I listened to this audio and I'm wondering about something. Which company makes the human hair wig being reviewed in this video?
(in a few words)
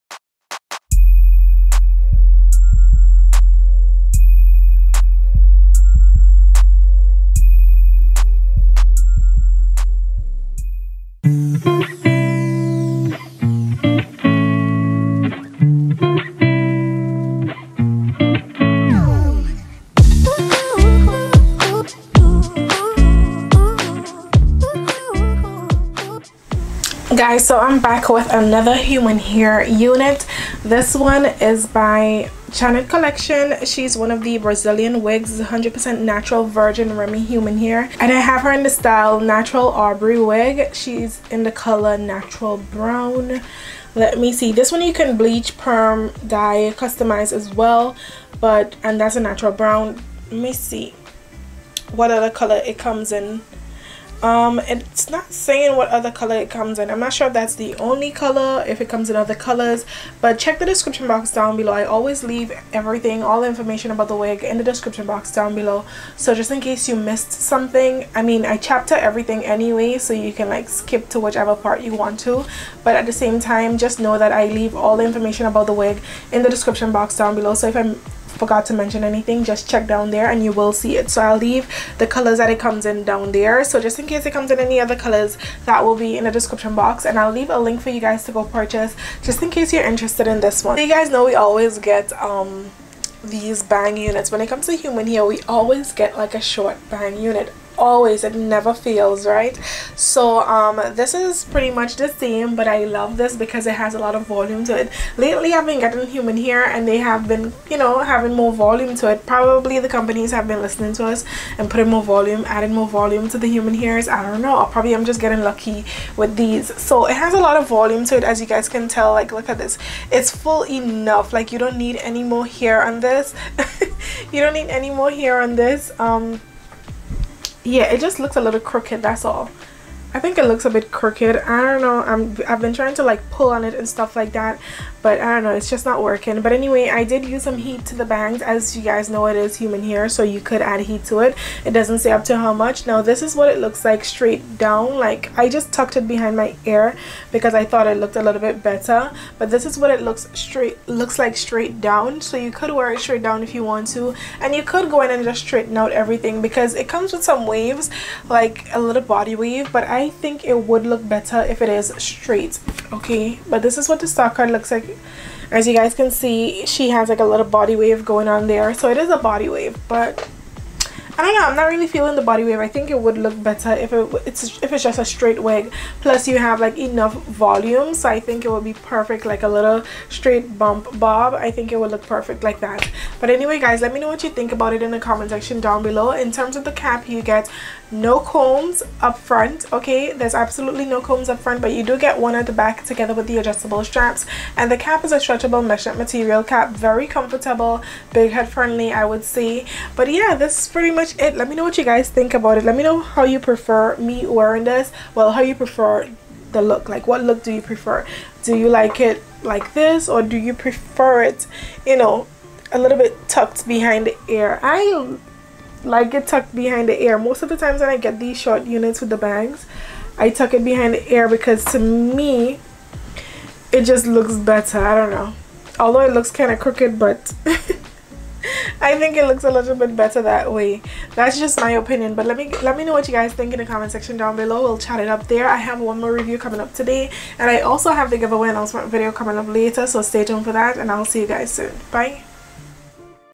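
Janet Collection.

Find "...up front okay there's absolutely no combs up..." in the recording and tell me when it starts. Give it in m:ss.
3:09.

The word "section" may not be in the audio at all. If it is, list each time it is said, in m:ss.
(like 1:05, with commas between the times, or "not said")
3:05, 3:53.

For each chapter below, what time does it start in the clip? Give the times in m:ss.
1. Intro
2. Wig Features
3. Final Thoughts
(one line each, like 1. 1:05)
1. 0:27
2. 0:44
3. 3:21.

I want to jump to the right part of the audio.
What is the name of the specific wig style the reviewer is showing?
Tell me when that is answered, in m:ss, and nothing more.
0:39.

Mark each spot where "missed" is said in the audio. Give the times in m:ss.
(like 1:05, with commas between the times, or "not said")
1:06.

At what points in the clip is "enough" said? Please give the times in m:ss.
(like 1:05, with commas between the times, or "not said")
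2:00, 2:56.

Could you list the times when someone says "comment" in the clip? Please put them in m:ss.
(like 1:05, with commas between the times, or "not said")
3:04, 3:53.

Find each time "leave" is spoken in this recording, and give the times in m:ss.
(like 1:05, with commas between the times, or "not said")
1:02, 1:14, 1:21, 1:27.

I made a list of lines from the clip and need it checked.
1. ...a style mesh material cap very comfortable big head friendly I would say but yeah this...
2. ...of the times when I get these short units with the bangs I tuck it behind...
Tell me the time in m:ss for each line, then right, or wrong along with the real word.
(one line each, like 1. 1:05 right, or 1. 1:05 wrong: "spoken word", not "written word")
1. 3:15 wrong: "stretchable", not "style"
2. 3:37 right.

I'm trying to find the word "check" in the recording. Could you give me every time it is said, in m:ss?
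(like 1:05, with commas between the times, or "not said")
1:00, 1:19.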